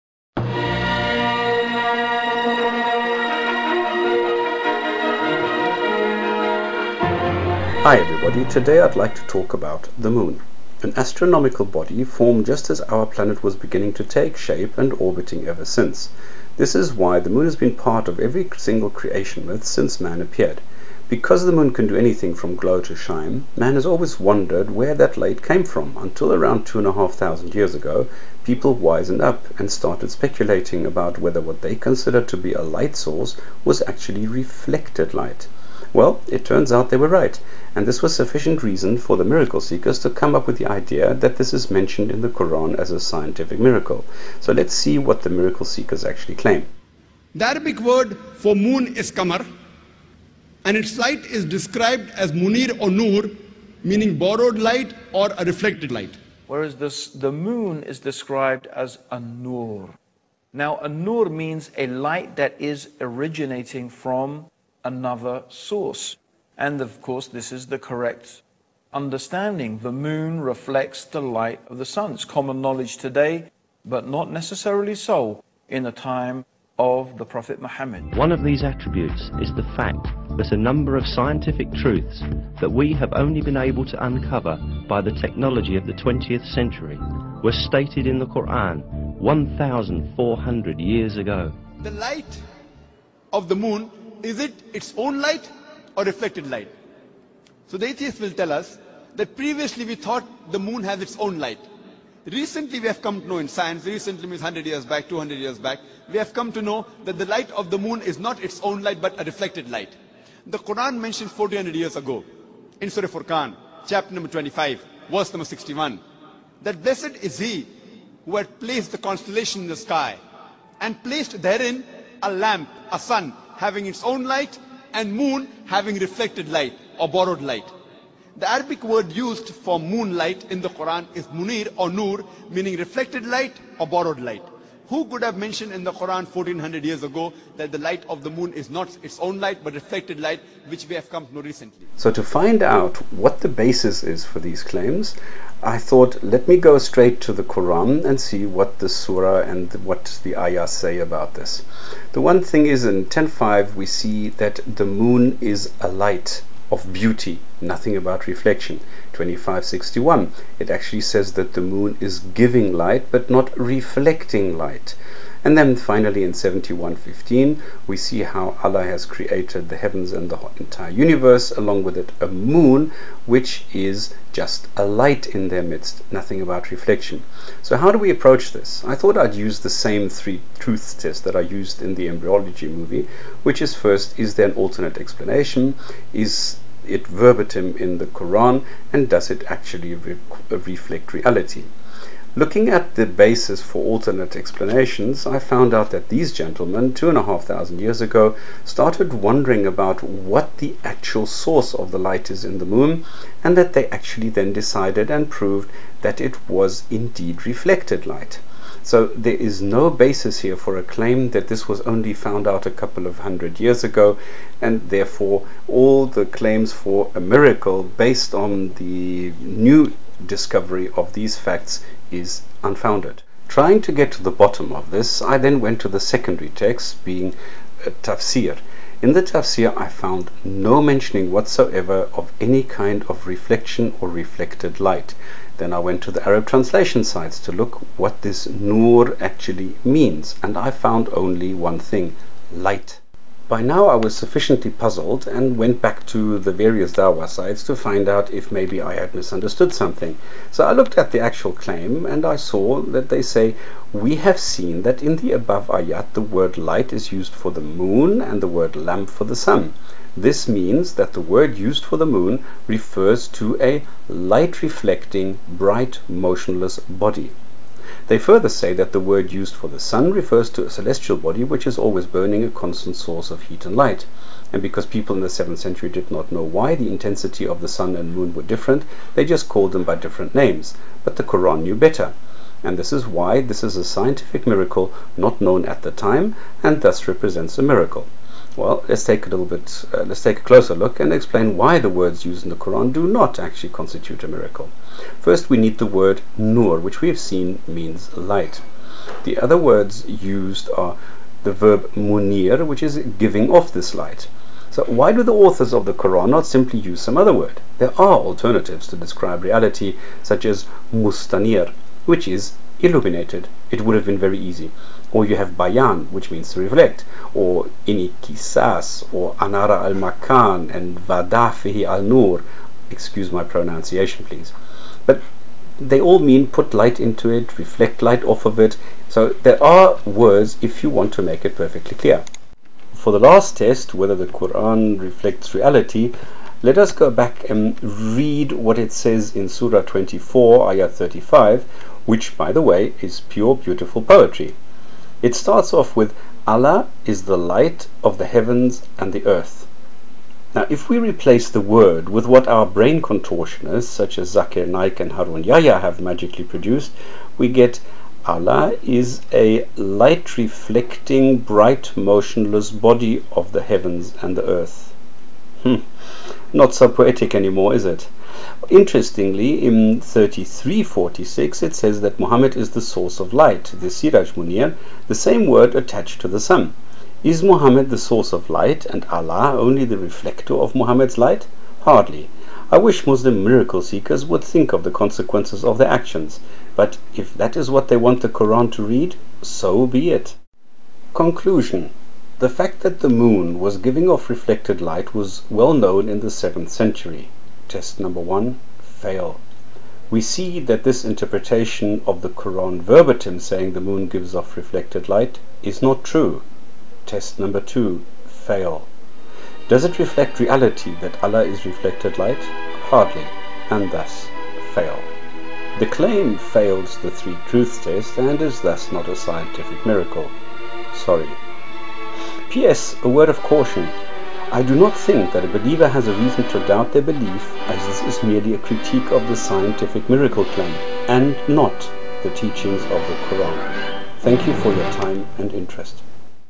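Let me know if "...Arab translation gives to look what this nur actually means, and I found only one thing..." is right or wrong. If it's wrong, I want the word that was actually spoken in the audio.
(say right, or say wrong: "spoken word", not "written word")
wrong: "sites", not "gives".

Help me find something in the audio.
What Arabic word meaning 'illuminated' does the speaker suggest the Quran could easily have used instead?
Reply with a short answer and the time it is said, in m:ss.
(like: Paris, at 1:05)
mustanir, at 5:10.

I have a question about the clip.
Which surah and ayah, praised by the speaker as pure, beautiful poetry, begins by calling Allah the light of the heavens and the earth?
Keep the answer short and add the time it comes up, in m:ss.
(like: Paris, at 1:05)
Surah 24, Ayah 35, at 5:39.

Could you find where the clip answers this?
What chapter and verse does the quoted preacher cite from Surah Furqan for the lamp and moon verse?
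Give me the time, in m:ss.
1:53.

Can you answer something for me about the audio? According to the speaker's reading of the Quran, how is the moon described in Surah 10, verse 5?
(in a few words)
A light of beauty.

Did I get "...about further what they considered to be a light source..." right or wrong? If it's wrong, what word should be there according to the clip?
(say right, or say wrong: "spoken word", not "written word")
wrong: "whether", not "further".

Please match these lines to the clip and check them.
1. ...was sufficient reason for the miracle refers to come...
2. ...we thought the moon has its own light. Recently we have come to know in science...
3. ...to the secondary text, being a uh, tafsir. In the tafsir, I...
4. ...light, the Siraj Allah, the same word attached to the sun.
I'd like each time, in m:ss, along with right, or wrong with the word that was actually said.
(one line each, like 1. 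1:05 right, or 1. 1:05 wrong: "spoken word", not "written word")
1. 0:38 wrong: "seekers", not "refers"
2. 1:39 right
3. 3:45 right
4. 6:13 wrong: "Munir", not "Allah".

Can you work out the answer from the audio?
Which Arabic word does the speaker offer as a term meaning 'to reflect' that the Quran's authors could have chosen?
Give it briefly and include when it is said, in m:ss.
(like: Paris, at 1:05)
bayan, at 5:15.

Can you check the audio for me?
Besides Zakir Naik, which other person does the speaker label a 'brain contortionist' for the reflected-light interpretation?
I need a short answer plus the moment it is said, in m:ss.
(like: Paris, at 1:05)
Harun Yahya, at 5:55.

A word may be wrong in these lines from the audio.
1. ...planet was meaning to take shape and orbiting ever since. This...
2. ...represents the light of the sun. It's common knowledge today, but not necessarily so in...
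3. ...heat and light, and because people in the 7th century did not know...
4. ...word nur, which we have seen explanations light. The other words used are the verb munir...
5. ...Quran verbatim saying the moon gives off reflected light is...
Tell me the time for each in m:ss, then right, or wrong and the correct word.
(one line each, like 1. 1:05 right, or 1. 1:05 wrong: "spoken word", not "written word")
1. 0:13 wrong: "beginning", not "meaning"
2. 1:10 wrong: "reflects", not "represents"
3. 4:33 right
4. 4:55 wrong: "means", not "explanations"
5. 6:42 right.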